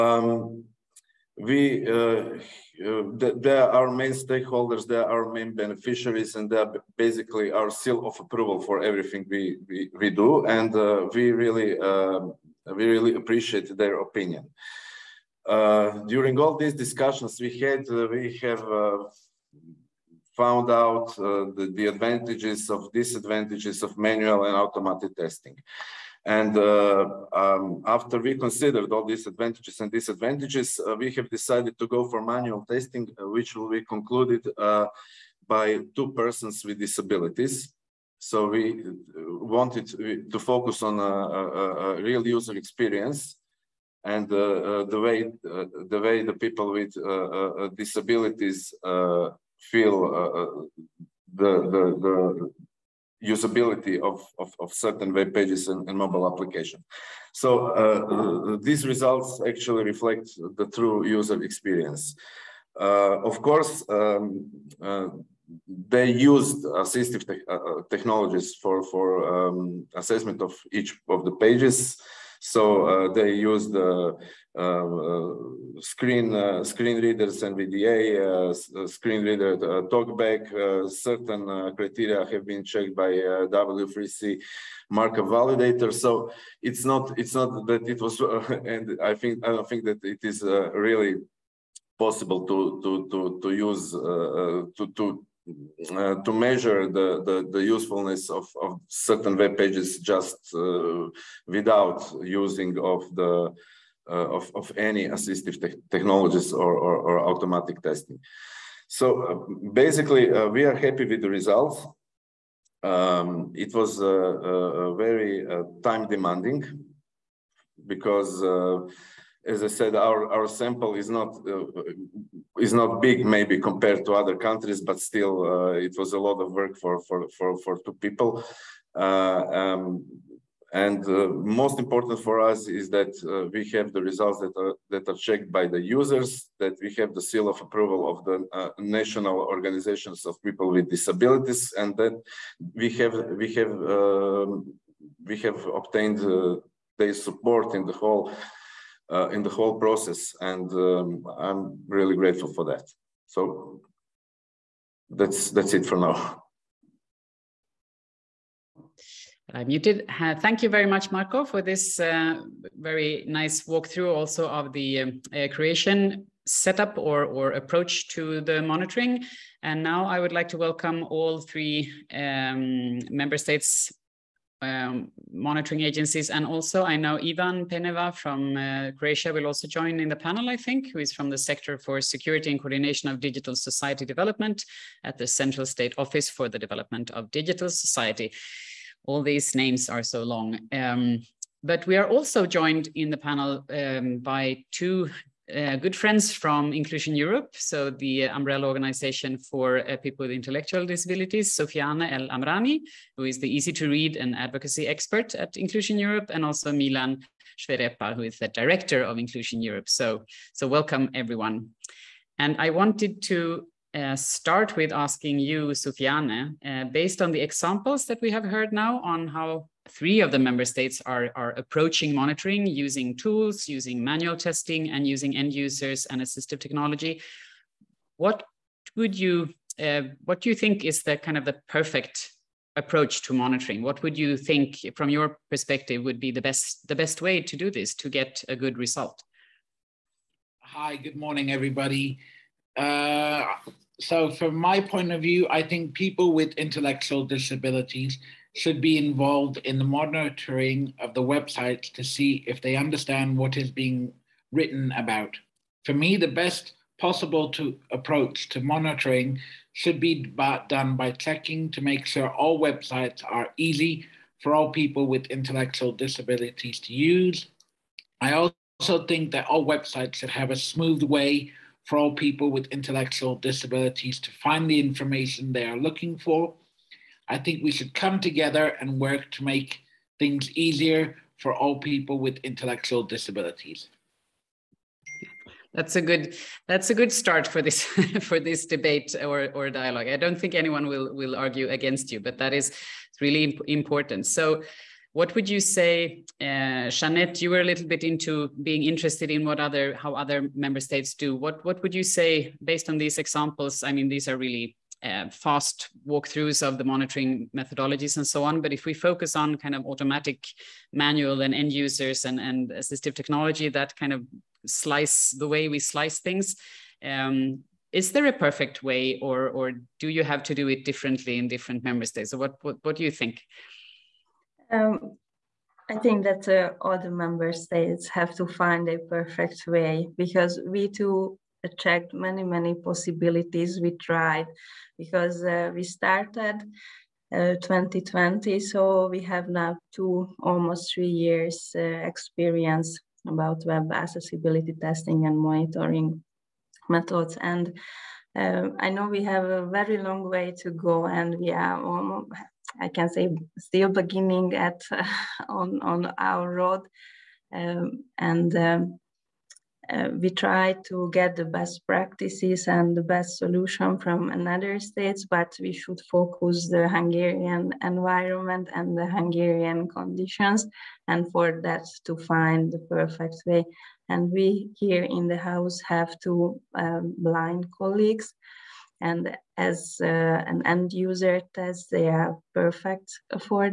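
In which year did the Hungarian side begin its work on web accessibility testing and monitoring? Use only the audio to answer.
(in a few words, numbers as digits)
2020.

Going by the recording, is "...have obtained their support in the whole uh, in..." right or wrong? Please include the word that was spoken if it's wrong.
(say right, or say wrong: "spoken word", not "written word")
right.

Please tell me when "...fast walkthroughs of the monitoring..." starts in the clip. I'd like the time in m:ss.
5:05.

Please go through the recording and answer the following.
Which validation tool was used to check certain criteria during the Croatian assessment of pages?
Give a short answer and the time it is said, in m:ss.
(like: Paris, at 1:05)
W3C markup validator, at 1:23.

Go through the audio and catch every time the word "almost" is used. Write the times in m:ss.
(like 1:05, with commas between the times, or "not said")
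5:40, 5:51.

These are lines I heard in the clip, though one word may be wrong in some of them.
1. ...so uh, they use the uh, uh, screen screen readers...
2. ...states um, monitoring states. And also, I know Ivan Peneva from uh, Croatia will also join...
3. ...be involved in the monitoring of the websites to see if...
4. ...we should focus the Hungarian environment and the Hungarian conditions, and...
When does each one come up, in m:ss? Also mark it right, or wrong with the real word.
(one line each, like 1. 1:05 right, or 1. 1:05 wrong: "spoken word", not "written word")
1. 1:12 right
2. 2:53 wrong: "agencies", not "states"
3. 4:08 right
4. 6:05 right.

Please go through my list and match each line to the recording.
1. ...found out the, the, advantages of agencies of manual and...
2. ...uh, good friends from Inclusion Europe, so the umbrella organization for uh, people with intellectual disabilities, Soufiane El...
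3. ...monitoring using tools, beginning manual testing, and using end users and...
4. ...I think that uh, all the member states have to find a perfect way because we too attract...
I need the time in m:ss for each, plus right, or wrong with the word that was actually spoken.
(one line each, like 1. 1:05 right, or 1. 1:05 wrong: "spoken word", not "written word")
1. 0:20 wrong: "disadvantages", not "agencies"
2. 3:15 right
3. 3:42 wrong: "using", not "beginning"
4. 5:25 right.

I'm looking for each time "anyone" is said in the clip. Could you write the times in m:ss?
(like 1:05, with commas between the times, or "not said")
4:50.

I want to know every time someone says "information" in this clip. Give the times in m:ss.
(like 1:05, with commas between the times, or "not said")
4:34.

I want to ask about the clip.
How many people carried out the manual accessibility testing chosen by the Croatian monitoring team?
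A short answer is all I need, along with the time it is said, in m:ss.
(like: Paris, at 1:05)
2, at 0:35.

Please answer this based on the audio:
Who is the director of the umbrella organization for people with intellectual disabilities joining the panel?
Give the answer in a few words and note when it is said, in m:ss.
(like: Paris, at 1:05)
Milan Šveřepa, at 3:26.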